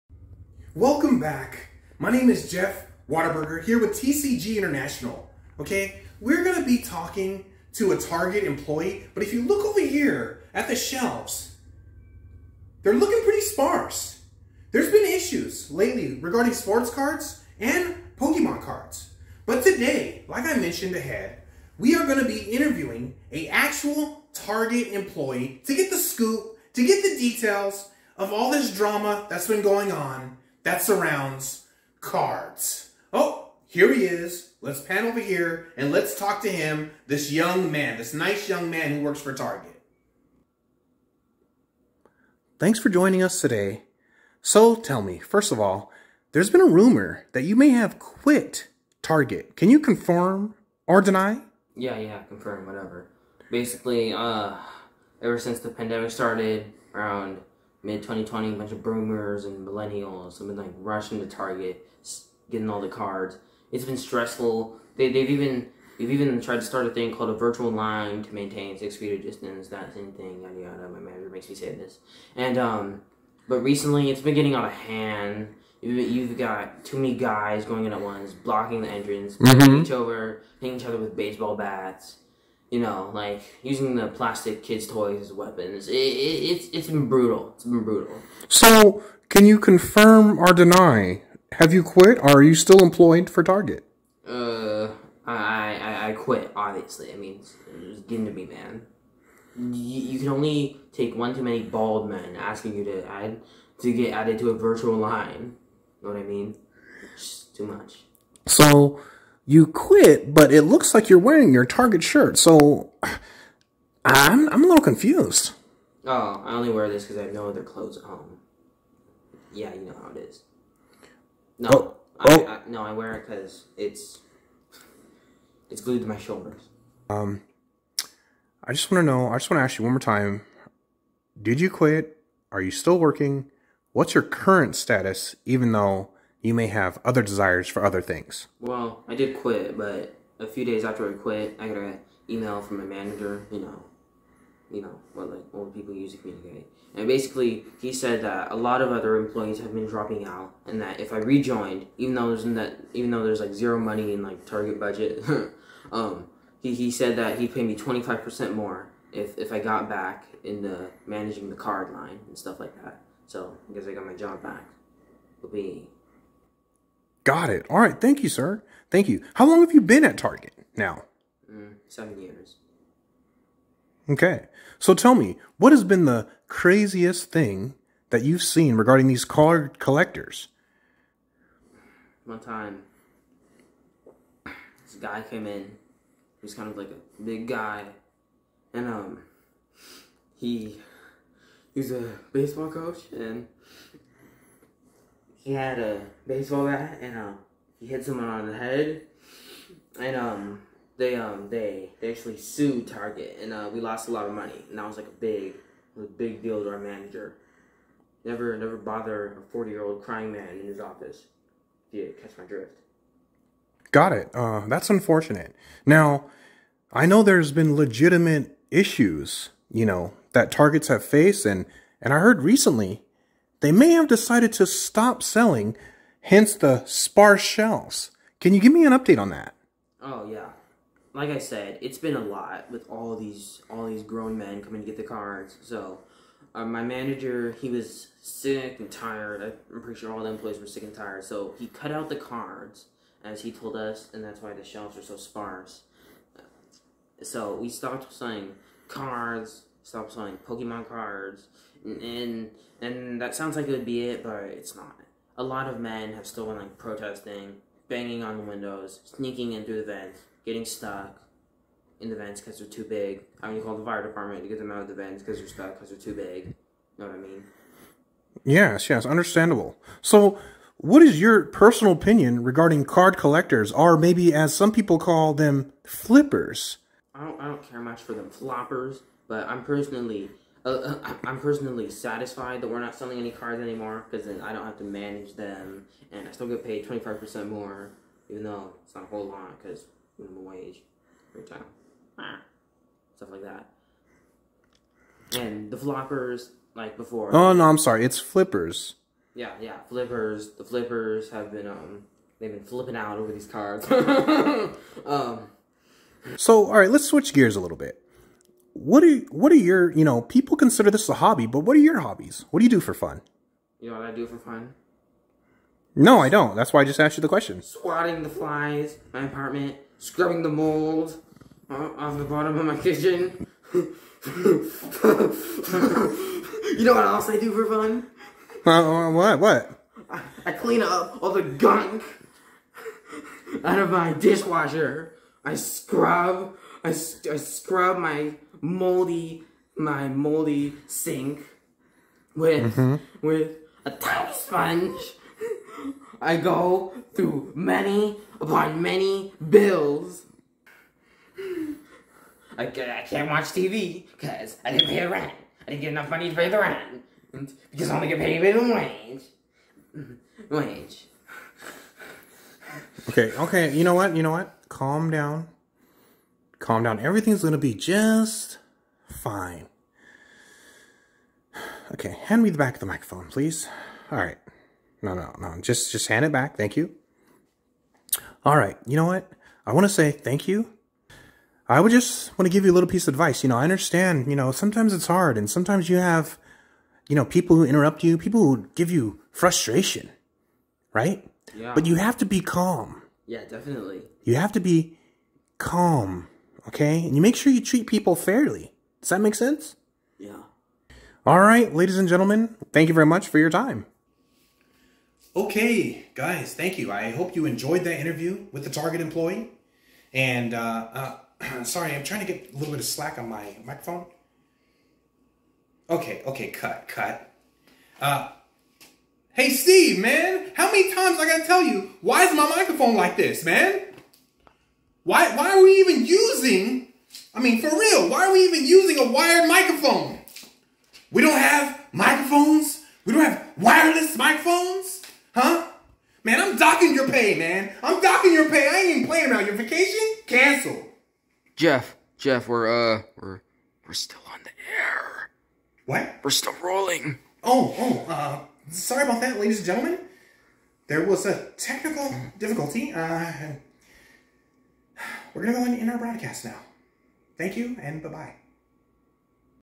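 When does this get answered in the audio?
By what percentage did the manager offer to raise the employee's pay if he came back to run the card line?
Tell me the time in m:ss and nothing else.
2:37.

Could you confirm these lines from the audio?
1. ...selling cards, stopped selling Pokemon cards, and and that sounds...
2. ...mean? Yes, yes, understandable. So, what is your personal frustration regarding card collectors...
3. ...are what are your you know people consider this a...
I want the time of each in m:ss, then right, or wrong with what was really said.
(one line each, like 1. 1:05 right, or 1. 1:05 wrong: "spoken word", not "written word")
1. 4:08 right
2. 4:27 wrong: "opinion", not "frustration"
3. 5:09 right.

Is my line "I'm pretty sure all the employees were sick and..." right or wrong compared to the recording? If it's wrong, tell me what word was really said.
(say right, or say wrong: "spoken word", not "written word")
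right.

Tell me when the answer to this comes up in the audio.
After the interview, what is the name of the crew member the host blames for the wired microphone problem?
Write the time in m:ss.
6:59.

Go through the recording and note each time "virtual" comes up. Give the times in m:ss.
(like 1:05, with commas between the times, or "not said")
1:07, 1:44.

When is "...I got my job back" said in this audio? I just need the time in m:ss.
2:43.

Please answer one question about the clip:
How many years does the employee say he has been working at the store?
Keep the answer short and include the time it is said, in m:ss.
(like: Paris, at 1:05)
7, at 2:51.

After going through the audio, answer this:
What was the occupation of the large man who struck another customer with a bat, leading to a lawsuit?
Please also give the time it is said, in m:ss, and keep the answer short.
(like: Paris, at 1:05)
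baseball coach, at 3:12.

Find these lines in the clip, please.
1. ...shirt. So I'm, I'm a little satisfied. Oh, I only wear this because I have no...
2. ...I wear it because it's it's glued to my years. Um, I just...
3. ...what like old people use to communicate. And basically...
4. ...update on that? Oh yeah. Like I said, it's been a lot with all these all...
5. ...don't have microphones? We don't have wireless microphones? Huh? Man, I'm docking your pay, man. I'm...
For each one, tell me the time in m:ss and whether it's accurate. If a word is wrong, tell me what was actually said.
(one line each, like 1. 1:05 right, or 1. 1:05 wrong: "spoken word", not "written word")
1. 1:52 wrong: "confused", not "satisfied"
2. 2:02 wrong: "shoulders", not "years"
3. 2:25 right
4. 3:48 right
5. 7:11 right.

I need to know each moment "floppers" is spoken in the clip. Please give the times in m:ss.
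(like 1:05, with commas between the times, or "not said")
4:38, 4:55.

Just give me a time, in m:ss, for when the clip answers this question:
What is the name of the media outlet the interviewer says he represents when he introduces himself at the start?
0:03.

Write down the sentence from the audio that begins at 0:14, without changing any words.
There's been issues lately regarding sports cards and Pokemon cards.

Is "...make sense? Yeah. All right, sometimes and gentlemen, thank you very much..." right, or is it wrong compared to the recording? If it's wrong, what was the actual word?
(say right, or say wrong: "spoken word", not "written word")
wrong: "ladies", not "sometimes".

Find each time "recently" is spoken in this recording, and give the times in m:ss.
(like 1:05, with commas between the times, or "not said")
1:13, 3:42.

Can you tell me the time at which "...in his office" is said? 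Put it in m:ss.
3:30.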